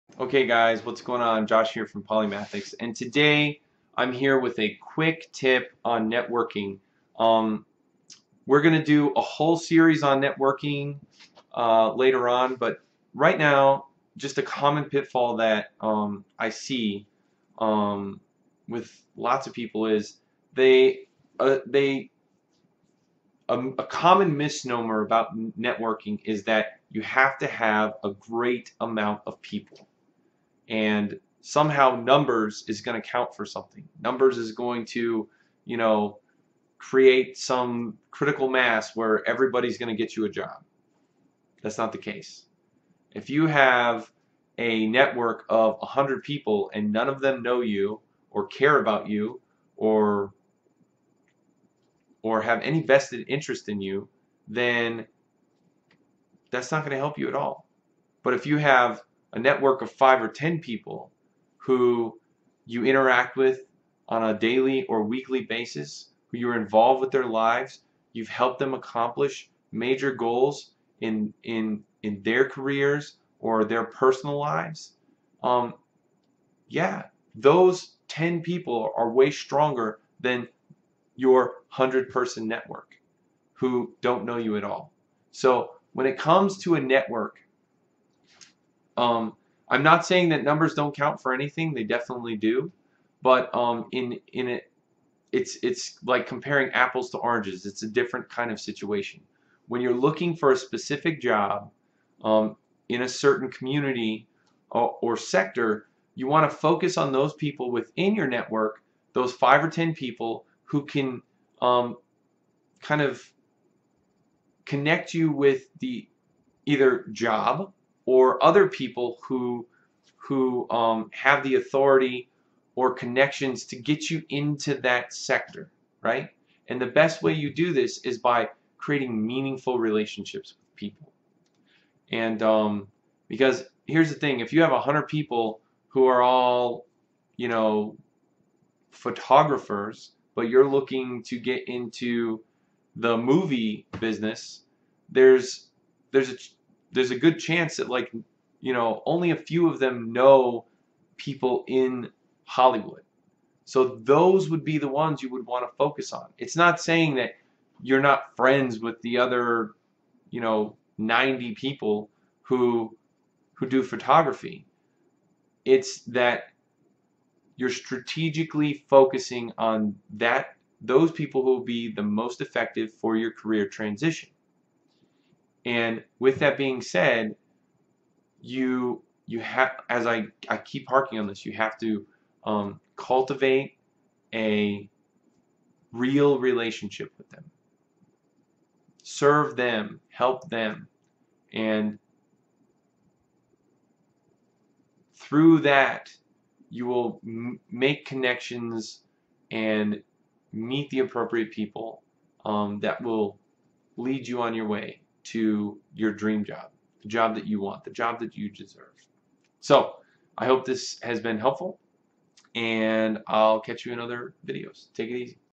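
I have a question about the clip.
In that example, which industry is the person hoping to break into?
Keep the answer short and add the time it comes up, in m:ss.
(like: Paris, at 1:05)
The movie business, at 2:23.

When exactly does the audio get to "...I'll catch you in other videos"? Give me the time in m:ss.
3:33.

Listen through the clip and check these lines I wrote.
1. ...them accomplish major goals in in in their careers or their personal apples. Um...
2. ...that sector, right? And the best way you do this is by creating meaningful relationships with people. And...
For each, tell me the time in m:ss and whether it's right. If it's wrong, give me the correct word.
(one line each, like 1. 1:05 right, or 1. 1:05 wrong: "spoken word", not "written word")
1. 1:08 wrong: "lives", not "apples"
2. 2:04 right.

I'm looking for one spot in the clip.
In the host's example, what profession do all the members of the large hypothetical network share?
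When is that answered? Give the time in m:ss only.
2:18.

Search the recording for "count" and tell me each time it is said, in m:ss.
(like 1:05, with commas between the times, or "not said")
0:33, 1:30.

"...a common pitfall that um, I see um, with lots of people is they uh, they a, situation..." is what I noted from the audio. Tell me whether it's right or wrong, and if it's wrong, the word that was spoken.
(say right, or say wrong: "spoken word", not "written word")
wrong: "common", not "situation".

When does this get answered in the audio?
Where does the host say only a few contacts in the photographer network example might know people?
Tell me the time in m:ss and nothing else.
2:32.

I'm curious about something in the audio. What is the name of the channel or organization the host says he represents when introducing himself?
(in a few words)
Polymathics.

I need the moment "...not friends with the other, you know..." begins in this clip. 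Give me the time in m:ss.
2:38.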